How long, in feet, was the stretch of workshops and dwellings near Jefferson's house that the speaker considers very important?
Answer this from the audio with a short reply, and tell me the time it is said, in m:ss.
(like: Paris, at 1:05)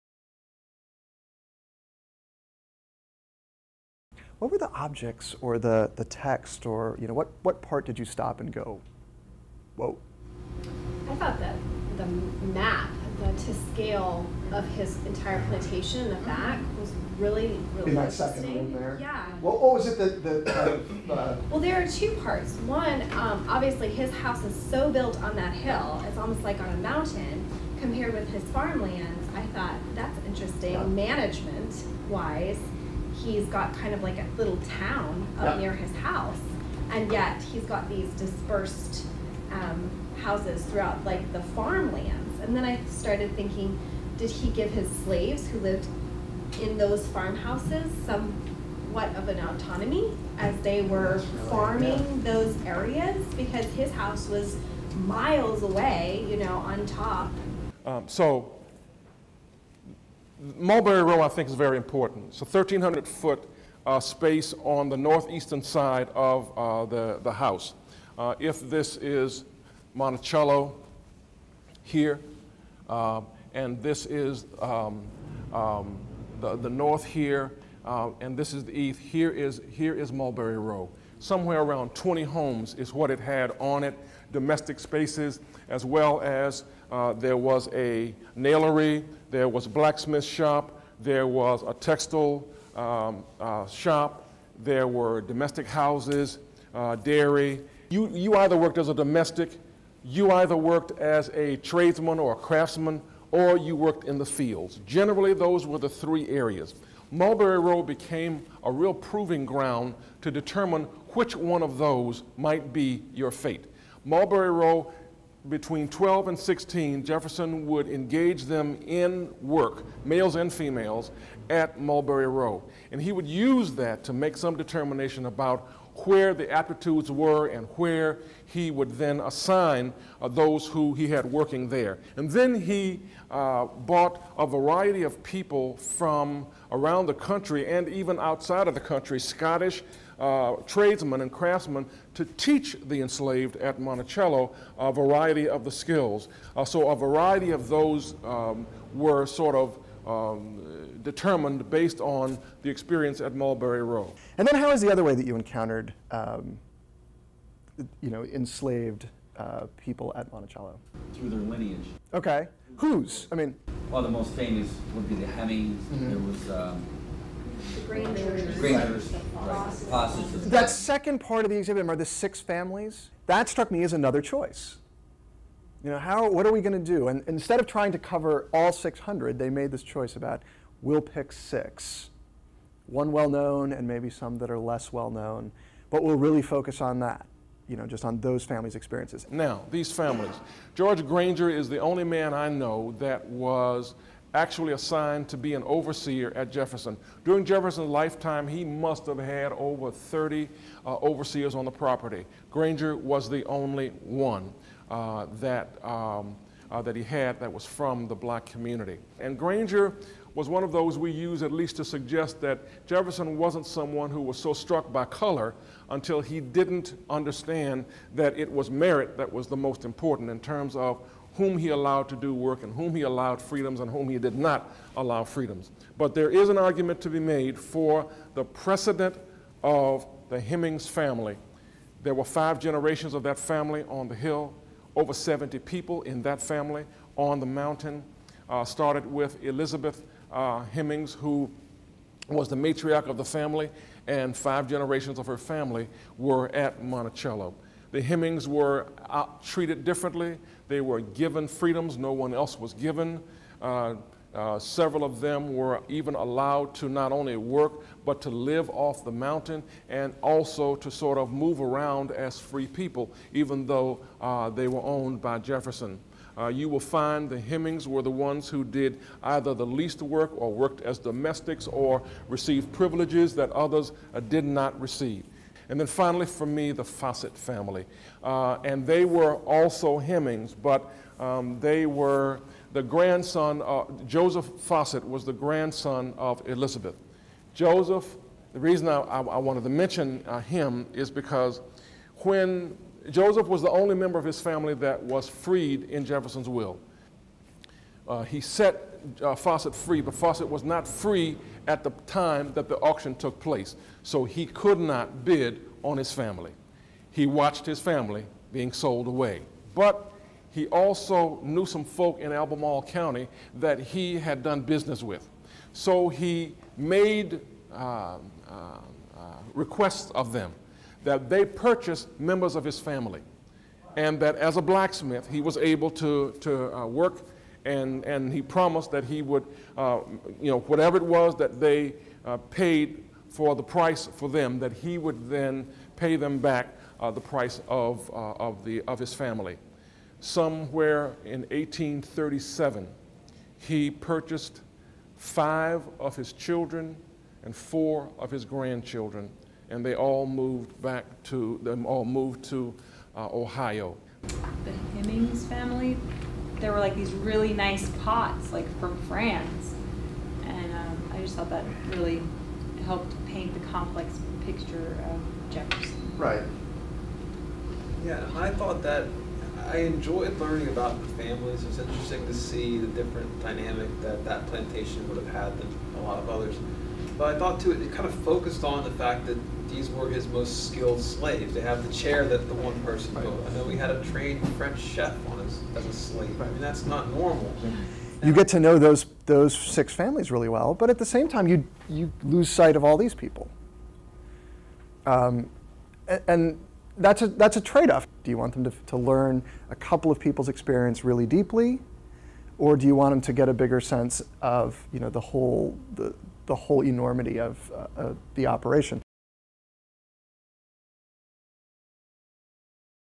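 1,300 feet, at 1:02.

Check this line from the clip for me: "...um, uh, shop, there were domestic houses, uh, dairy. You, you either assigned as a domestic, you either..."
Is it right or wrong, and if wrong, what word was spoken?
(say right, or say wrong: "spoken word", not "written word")
wrong: "worked", not "assigned".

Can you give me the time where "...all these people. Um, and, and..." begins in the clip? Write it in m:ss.
6:32.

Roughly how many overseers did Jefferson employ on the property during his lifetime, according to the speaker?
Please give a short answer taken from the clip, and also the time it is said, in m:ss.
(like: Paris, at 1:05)
over 30, at 3:19.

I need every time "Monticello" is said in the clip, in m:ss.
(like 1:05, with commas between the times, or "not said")
1:09, 2:23, 2:40, 4:06.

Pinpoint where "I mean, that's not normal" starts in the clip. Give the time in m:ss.
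6:26.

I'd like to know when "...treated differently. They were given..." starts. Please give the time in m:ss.
4:09.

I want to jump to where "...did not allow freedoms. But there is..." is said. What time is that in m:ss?
3:44.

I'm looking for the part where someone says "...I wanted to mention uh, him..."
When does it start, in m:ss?
4:49.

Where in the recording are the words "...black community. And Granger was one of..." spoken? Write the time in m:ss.
3:28.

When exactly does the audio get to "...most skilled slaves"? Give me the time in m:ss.
6:20.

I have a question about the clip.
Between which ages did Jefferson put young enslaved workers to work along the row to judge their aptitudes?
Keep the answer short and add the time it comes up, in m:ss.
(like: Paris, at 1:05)
12 and 16, at 1:55.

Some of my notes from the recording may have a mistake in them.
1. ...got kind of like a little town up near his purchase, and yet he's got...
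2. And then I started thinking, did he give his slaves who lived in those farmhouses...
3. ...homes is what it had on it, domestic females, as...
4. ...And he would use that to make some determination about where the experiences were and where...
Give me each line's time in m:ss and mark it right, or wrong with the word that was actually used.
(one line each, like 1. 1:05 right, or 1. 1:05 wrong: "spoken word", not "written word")
1. 0:33 wrong: "house", not "purchase"
2. 0:42 right
3. 1:22 wrong: "spaces", not "females"
4. 2:02 wrong: "aptitudes", not "experiences".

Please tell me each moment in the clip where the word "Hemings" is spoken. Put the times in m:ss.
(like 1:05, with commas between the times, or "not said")
2:45, 3:50, 4:00, 4:08, 4:27, 4:39, 5:54.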